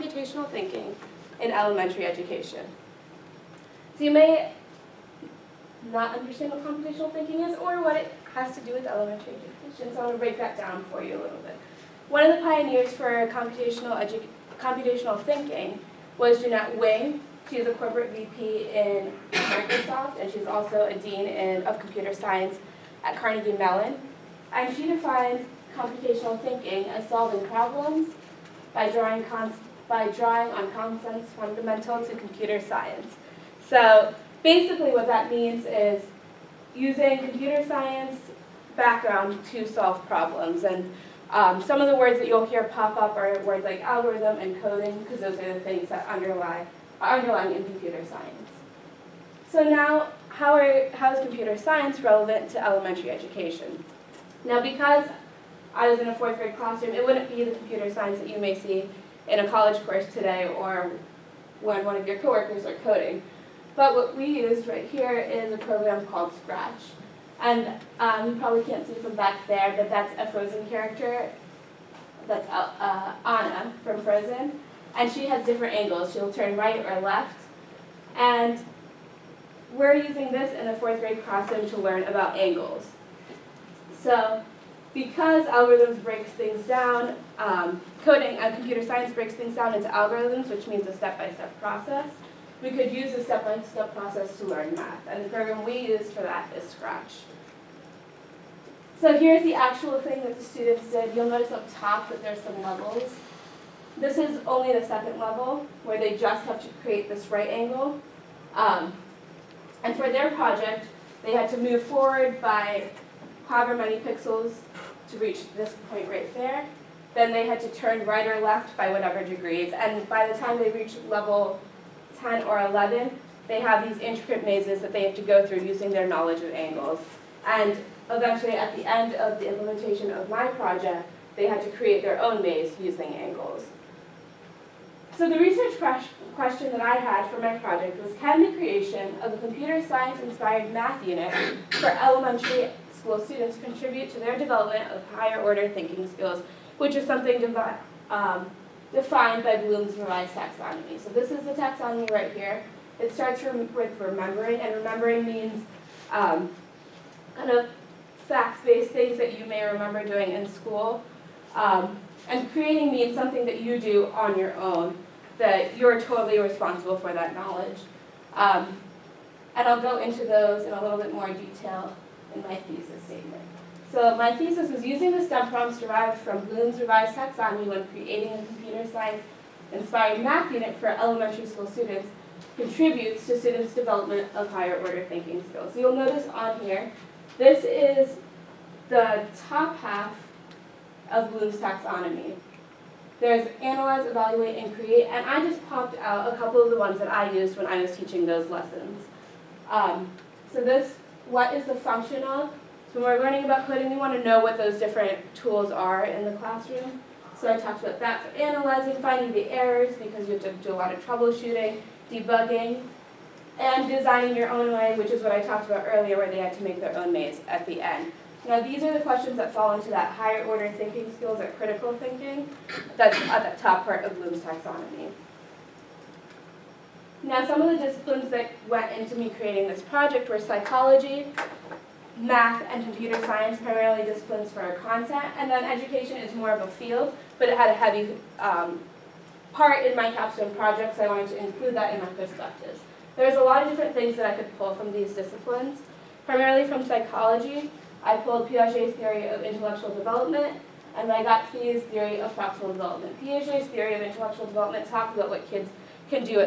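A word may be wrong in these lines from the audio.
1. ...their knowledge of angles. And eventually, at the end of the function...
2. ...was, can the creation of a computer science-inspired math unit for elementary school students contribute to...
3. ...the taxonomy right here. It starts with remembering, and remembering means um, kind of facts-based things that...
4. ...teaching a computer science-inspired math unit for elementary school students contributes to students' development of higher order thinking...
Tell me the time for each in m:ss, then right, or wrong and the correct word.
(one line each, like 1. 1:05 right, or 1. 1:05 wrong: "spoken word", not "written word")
1. 2:05 wrong: "implementation", not "function"
2. 2:18 right
3. 2:31 right
4. 2:57 wrong: "creating", not "teaching".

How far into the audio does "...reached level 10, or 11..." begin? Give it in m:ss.
2:00.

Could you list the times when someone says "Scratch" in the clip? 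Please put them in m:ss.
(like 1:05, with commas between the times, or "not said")
1:06, 1:36.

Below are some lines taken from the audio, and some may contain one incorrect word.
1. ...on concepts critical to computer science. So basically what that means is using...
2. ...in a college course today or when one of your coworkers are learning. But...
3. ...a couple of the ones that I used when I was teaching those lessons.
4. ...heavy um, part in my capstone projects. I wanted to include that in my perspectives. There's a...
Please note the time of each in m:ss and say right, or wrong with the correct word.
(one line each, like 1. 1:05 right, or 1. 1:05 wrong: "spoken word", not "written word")
1. 0:30 wrong: "fundamental", not "critical"
2. 0:59 wrong: "coding", not "learning"
3. 3:16 right
4. 3:57 right.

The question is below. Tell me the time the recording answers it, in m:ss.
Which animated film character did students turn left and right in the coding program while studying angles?
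1:13.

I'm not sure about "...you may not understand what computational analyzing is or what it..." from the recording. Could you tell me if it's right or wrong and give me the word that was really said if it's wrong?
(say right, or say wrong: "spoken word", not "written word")
wrong: "thinking", not "analyzing".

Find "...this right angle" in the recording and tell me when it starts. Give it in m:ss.
1:47.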